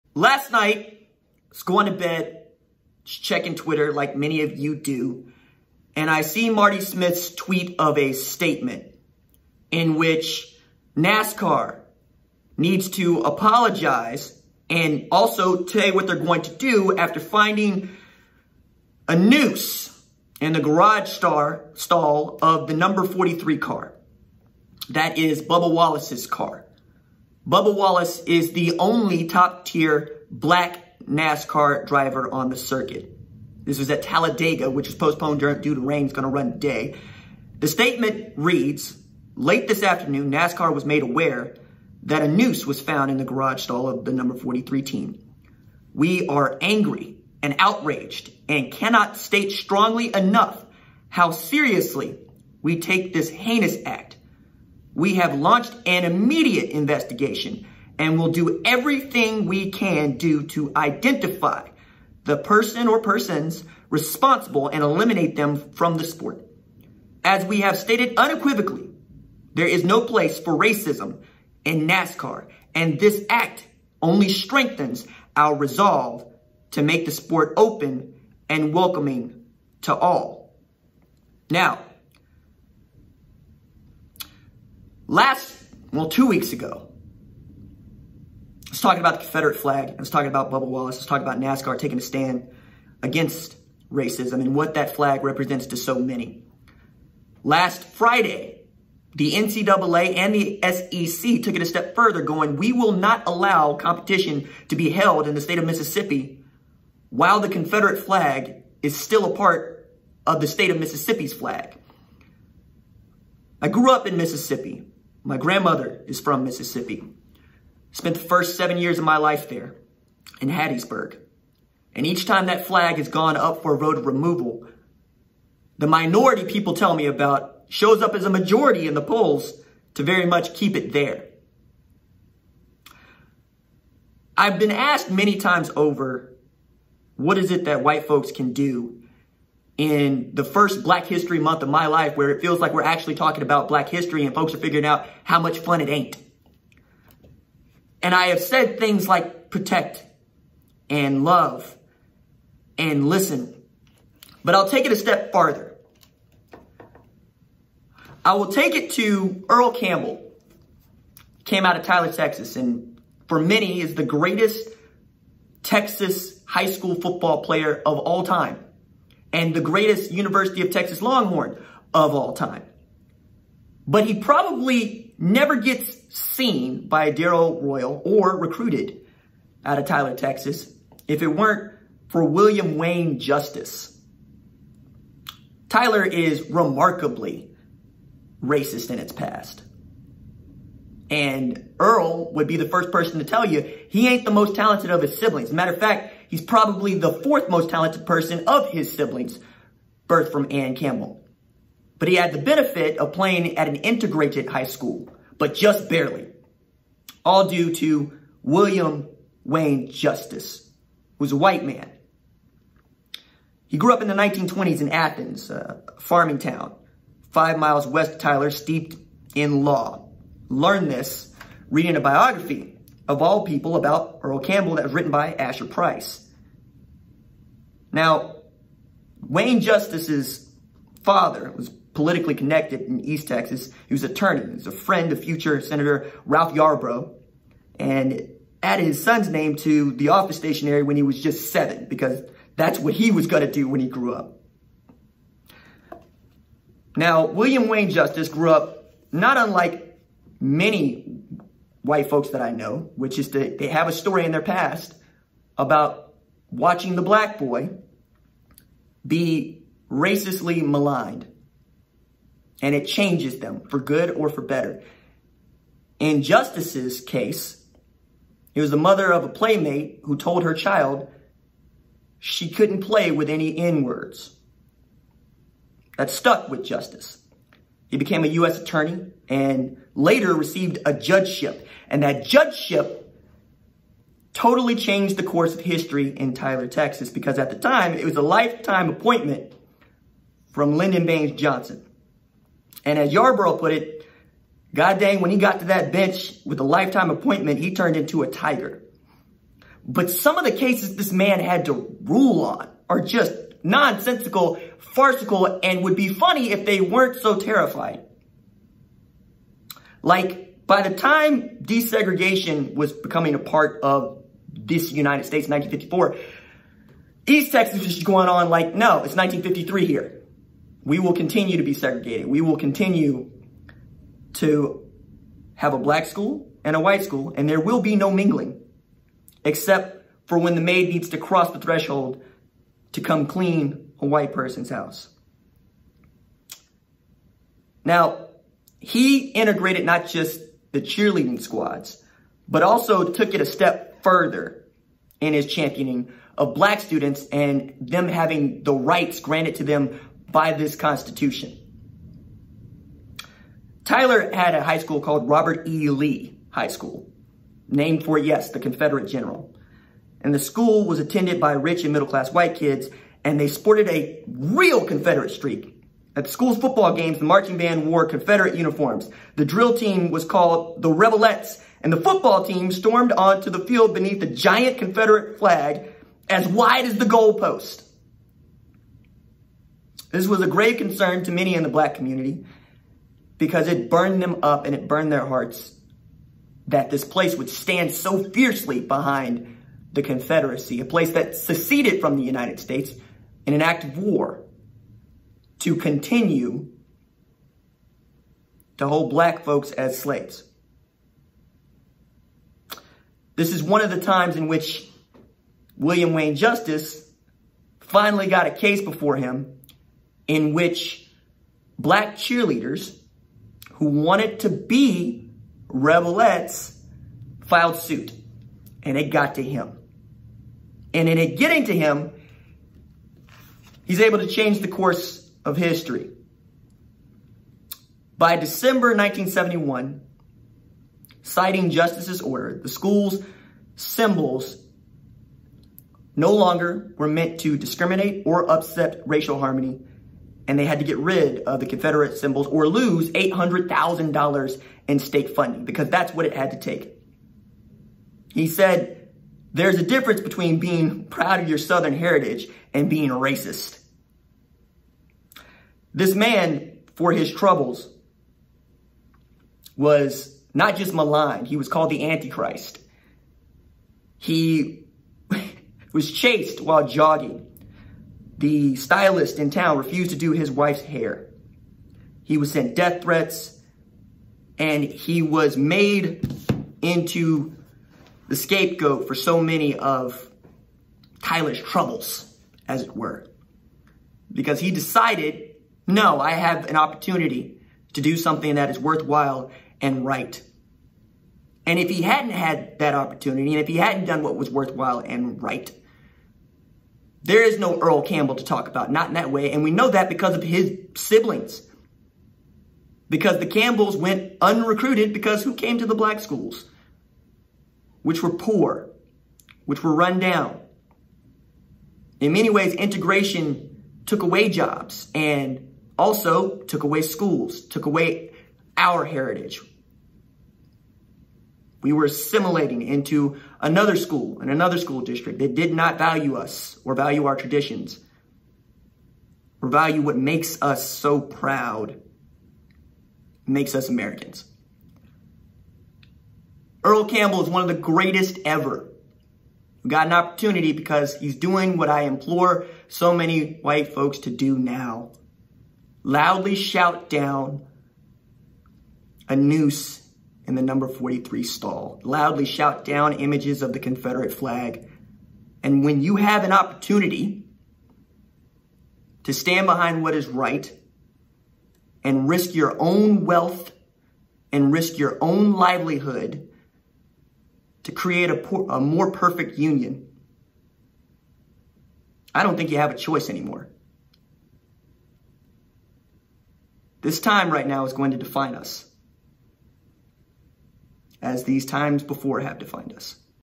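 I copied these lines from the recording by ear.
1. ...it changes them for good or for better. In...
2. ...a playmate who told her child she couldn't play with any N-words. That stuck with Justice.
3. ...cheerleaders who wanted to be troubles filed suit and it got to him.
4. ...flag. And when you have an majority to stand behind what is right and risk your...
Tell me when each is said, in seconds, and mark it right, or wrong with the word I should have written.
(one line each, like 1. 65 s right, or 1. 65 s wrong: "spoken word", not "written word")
1. 262 s right
2. 269 s right
3. 412 s wrong: "rebelettes", not "troubles"
4. 554 s wrong: "opportunity", not "majority".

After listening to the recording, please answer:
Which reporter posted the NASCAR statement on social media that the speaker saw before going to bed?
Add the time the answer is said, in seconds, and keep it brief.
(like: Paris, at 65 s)
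Marty Smith, at 6 s.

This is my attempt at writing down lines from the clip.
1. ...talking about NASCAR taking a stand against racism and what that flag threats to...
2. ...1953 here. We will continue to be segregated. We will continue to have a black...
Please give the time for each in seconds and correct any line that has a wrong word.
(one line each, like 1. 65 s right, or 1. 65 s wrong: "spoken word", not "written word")
1. 91 s wrong: "represents", not "threats"
2. 319 s right.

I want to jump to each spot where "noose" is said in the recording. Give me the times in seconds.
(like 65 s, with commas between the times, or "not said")
19 s, 42 s, 549 s.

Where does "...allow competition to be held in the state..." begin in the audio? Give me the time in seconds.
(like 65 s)
103 s.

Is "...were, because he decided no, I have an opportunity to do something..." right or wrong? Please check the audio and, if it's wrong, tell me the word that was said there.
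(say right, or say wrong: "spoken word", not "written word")
right.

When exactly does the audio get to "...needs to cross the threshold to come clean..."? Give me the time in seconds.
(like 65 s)
330 s.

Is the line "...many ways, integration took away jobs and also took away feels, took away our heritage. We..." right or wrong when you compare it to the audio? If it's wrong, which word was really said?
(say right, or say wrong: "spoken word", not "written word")
wrong: "schools", not "feels".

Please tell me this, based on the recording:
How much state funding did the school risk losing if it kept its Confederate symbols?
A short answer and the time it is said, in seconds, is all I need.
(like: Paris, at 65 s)
$800,000, at 443 s.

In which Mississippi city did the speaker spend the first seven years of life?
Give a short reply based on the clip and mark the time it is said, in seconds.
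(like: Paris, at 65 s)
Hattiesburg, at 120 s.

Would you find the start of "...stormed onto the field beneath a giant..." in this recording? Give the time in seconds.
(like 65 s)
372 s.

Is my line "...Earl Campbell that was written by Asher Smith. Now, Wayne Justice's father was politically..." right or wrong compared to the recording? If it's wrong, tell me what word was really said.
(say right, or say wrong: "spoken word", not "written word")
wrong: "Price", not "Smith".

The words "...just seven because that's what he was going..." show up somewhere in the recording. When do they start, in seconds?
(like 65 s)
241 s.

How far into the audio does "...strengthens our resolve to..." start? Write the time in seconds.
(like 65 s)
74 s.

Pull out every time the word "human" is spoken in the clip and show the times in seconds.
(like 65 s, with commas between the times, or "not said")
not said.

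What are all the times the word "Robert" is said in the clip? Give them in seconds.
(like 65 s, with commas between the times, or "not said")
355 s.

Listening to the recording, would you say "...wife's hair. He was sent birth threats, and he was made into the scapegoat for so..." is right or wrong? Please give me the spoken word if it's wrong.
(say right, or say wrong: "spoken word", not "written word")
wrong: "death", not "birth".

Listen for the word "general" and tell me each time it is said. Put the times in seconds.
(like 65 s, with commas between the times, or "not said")
359 s.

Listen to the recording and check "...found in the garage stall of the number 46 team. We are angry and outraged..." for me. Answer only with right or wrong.
wrong.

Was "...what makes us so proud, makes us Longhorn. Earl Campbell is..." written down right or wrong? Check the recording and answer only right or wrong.
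wrong.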